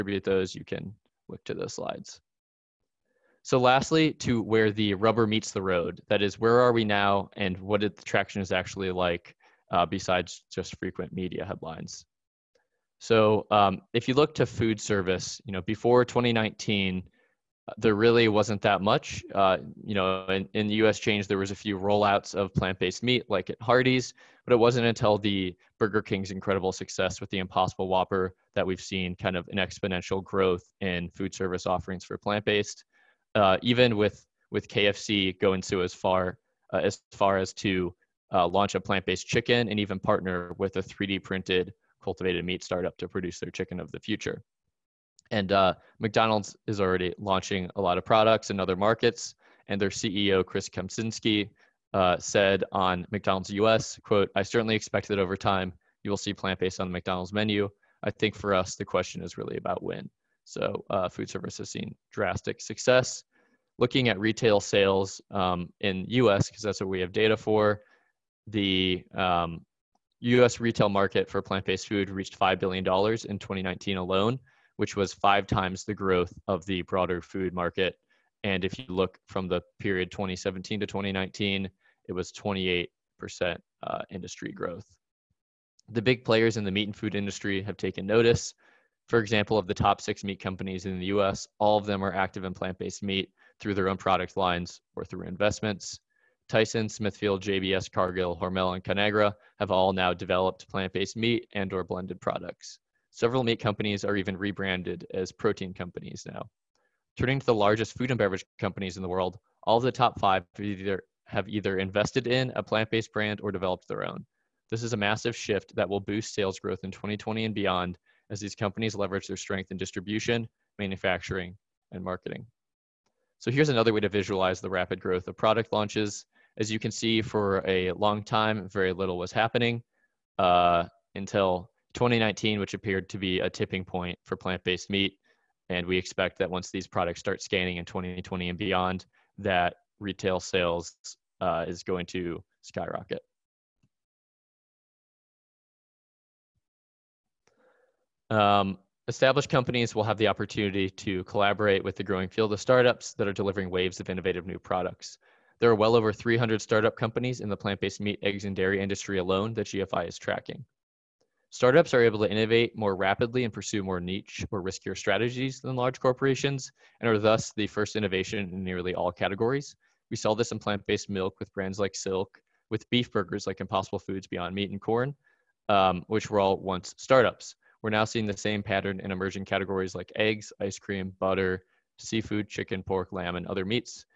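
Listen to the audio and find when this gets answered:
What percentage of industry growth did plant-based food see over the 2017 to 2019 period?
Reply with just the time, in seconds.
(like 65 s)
82 s.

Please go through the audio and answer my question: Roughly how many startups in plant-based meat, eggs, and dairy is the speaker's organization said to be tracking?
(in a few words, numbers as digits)
over 300.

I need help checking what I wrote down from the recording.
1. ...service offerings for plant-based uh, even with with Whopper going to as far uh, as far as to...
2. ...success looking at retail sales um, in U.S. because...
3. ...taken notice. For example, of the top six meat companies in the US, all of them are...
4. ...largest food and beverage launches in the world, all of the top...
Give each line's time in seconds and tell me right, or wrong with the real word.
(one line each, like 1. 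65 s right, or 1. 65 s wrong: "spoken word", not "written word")
1. 31 s wrong: "KFC", not "Whopper"
2. 62 s right
3. 87 s right
4. 107 s wrong: "companies", not "launches".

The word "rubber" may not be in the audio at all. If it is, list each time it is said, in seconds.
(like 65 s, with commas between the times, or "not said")
4 s.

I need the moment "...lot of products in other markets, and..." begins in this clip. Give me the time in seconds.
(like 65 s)
47 s.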